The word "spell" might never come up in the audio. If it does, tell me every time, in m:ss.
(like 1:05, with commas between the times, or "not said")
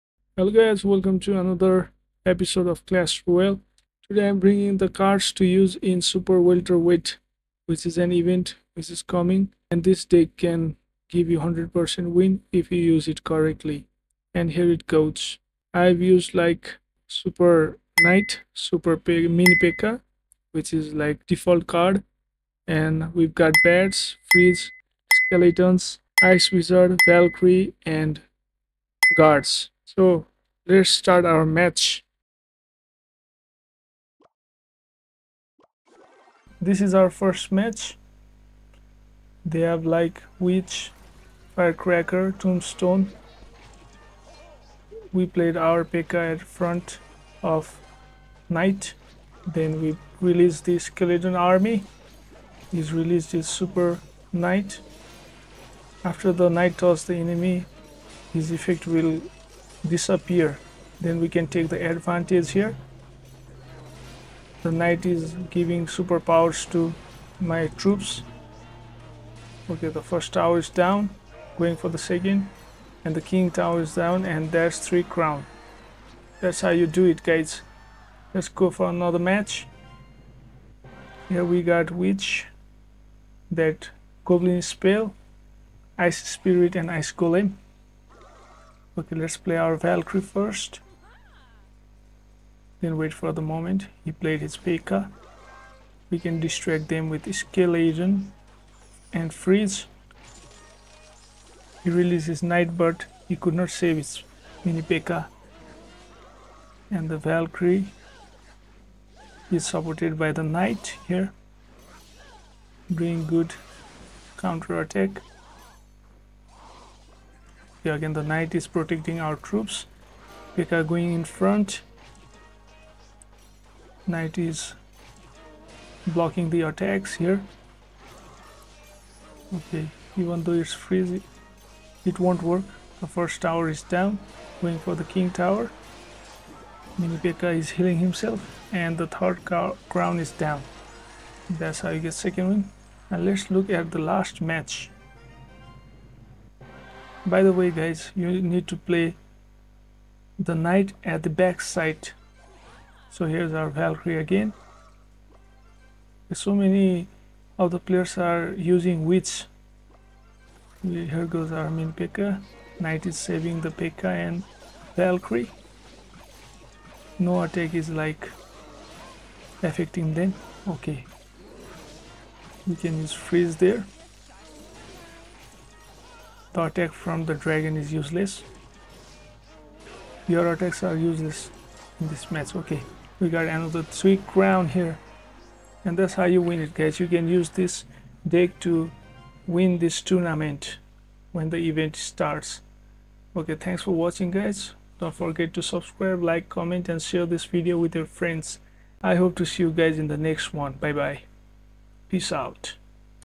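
1:24.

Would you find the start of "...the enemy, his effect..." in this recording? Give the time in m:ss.
0:57.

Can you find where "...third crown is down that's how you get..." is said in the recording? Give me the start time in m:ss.
2:19.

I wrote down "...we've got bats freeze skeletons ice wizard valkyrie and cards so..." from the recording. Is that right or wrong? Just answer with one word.
wrong.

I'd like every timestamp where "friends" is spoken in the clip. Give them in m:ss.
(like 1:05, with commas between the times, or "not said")
3:18.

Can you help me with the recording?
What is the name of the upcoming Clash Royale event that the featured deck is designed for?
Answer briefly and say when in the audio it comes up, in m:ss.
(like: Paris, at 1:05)
Super Welterweight, at 0:06.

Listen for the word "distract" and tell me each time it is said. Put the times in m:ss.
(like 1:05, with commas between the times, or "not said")
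1:36.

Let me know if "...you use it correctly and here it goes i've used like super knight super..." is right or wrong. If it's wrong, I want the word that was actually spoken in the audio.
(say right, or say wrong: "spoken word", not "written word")
right.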